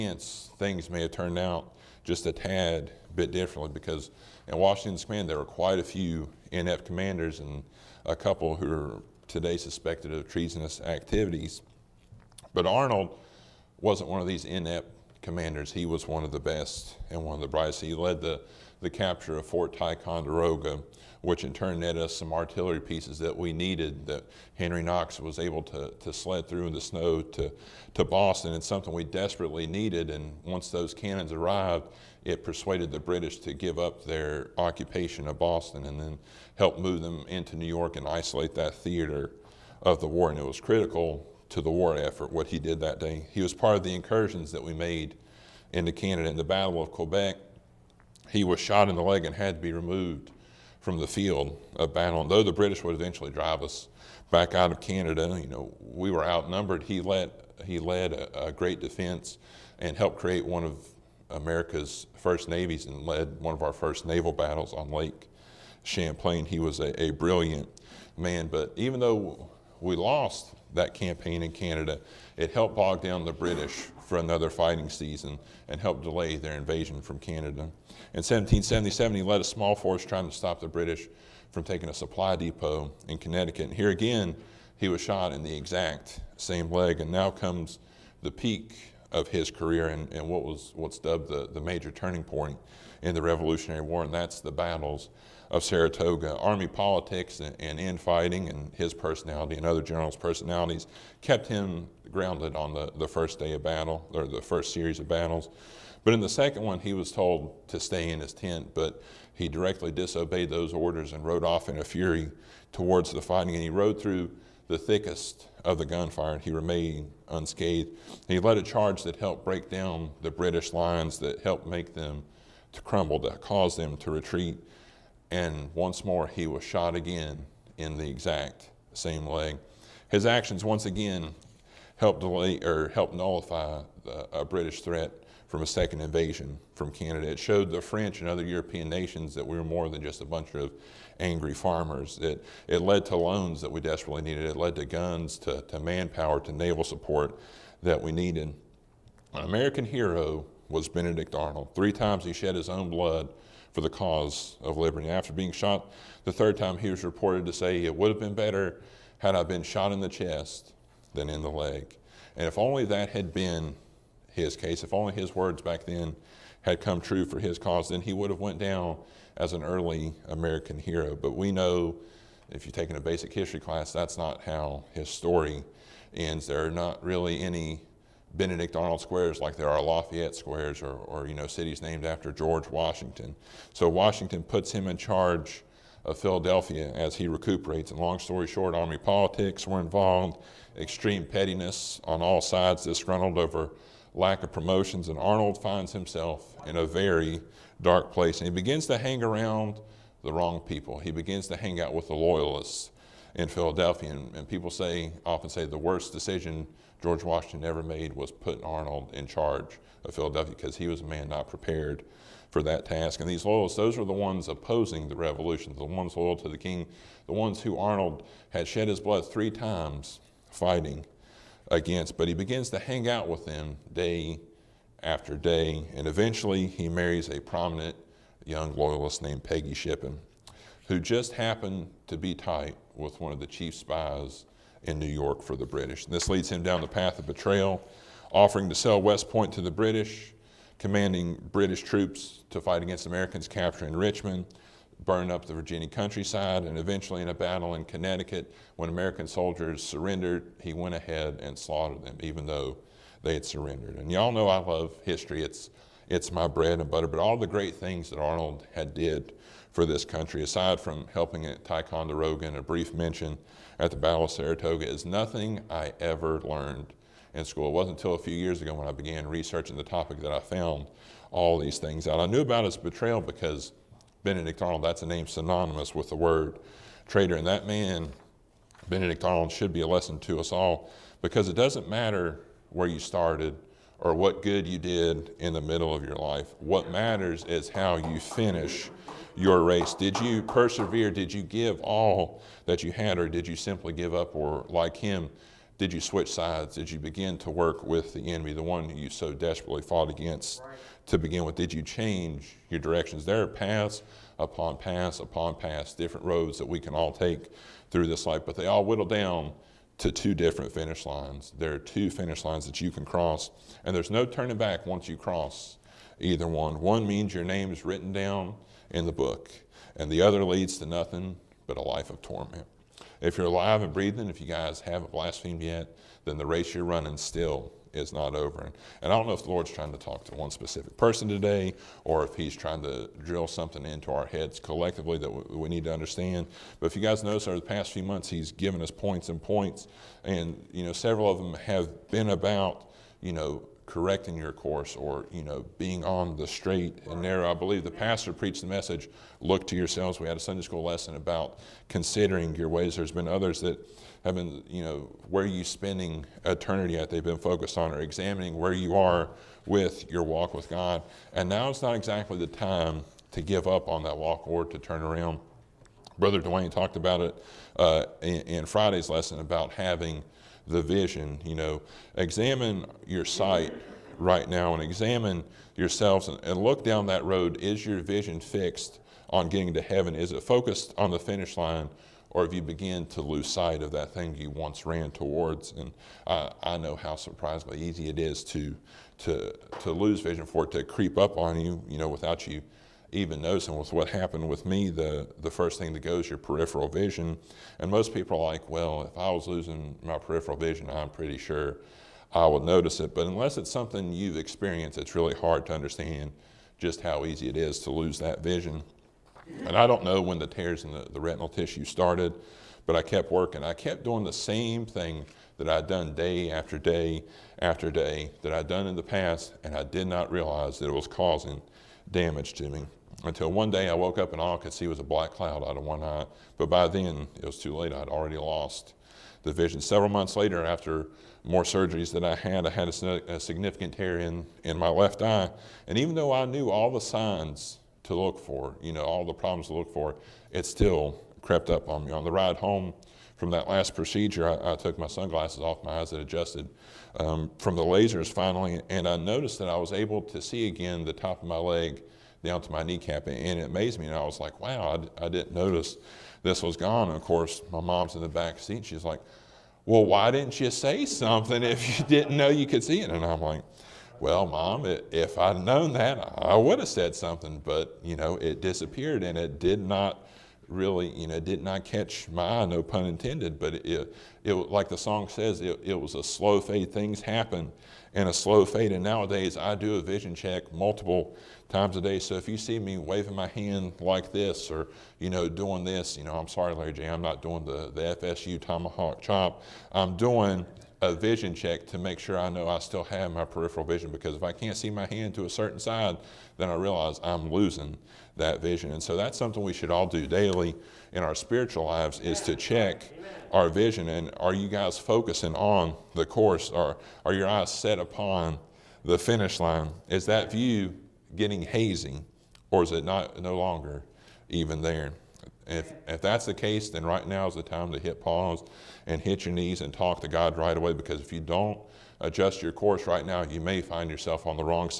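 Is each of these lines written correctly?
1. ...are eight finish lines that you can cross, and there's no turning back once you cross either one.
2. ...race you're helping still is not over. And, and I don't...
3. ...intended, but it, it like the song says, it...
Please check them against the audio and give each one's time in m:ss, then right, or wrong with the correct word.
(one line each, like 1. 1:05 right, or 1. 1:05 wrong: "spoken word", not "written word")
1. 5:11 wrong: "two", not "eight"
2. 5:26 wrong: "running", not "helping"
3. 7:53 right.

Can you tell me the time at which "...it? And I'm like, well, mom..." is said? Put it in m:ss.
7:43.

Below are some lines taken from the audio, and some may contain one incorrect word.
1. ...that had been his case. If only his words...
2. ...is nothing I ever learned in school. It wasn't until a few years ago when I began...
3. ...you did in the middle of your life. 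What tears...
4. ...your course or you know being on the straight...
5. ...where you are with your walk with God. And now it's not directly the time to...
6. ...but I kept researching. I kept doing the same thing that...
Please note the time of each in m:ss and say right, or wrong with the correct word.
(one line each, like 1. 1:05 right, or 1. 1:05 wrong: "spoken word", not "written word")
1. 2:42 right
2. 4:24 right
3. 4:44 wrong: "matters", not "tears"
4. 5:44 right
5. 5:58 wrong: "exactly", not "directly"
6. 6:52 wrong: "working", not "researching".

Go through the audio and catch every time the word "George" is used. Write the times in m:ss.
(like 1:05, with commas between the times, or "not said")
3:02, 3:27.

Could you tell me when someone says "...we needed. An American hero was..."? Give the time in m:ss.
2:28.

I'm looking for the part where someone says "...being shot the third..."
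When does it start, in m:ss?
2:35.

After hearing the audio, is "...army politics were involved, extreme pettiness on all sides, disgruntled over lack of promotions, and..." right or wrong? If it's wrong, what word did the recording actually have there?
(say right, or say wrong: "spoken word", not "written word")
right.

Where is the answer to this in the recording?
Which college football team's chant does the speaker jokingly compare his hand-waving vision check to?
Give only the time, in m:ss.
8:08.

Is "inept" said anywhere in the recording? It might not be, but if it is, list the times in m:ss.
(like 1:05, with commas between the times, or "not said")
0:06, 0:14.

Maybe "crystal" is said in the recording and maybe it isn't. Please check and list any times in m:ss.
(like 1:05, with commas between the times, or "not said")
not said.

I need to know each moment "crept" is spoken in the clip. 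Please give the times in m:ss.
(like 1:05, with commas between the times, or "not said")
7:21.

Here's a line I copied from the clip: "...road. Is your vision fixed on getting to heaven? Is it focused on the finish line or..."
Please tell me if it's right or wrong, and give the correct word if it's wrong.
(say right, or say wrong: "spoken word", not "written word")
right.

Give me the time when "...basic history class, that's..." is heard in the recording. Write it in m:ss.
2:53.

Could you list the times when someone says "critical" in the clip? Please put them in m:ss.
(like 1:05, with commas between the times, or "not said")
0:40.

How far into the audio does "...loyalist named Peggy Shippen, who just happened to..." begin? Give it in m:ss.
3:48.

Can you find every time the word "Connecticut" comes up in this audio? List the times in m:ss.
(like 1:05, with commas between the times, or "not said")
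1:23, 4:07.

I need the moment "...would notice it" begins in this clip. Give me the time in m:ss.
6:42.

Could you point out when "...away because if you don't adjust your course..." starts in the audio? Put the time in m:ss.
8:40.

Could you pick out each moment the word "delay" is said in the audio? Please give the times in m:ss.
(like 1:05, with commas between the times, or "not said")
1:16, 2:12.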